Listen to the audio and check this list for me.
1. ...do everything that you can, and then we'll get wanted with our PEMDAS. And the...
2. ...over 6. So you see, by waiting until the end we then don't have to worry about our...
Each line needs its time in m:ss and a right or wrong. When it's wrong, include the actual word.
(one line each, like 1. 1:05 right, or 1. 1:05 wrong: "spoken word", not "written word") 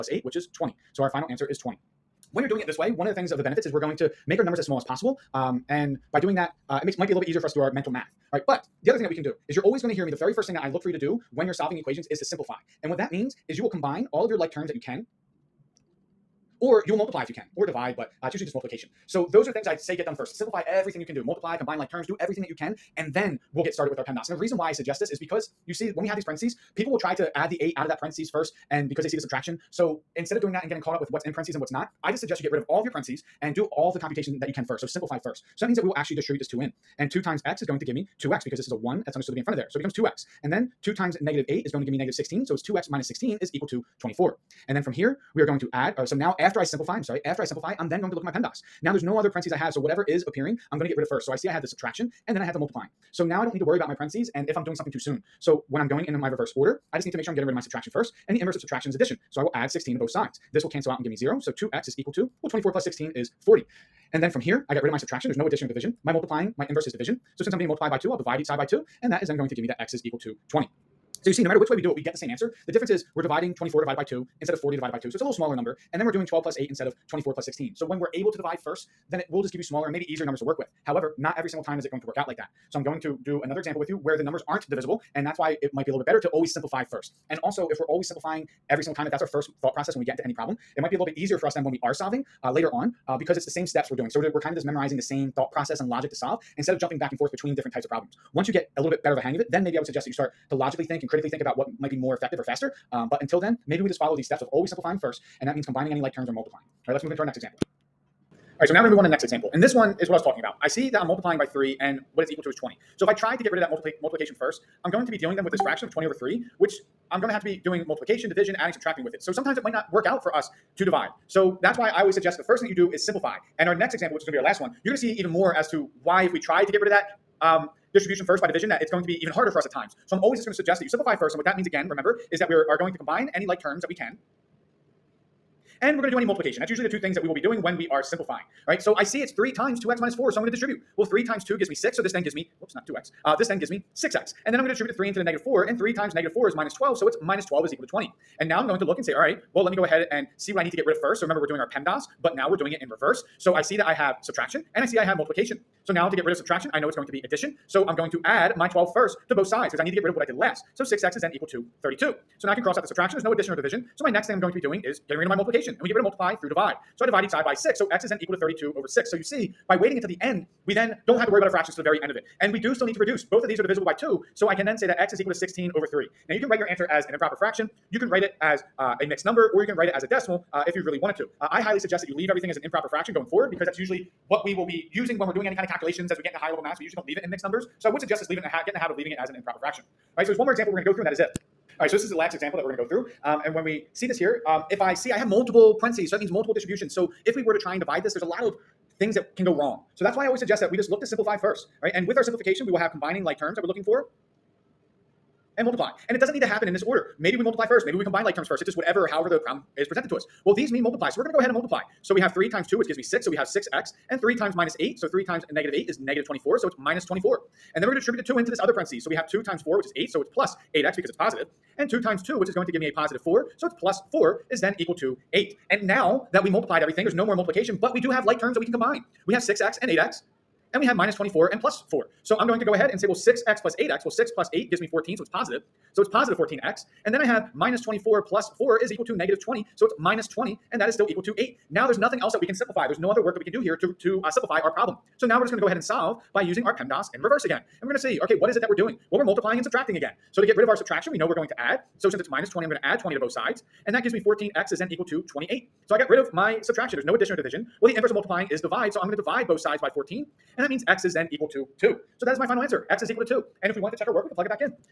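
1. 0:22 wrong: "started", not "wanted"
2. 2:48 right.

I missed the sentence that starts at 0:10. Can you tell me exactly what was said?
The very first thing that I look for you to do when you're solving equations is to simplify.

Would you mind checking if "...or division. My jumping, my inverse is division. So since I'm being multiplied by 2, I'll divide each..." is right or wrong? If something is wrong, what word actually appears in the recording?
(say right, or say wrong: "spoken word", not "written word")
wrong: "multiplying", not "jumping".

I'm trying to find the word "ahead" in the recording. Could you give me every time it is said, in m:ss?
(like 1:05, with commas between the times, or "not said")
2:29, 3:31, 3:52, 4:05.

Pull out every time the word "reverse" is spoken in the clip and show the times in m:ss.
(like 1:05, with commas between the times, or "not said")
0:56, 2:32, 4:07.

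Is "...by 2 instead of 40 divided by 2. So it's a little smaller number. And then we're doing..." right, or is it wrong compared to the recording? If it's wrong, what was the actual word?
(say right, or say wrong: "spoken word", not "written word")
right.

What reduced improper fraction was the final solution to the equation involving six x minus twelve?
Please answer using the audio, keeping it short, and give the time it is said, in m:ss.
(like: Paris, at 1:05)
16/3, at 2:55.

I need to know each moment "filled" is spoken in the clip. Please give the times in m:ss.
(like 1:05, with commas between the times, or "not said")
not said.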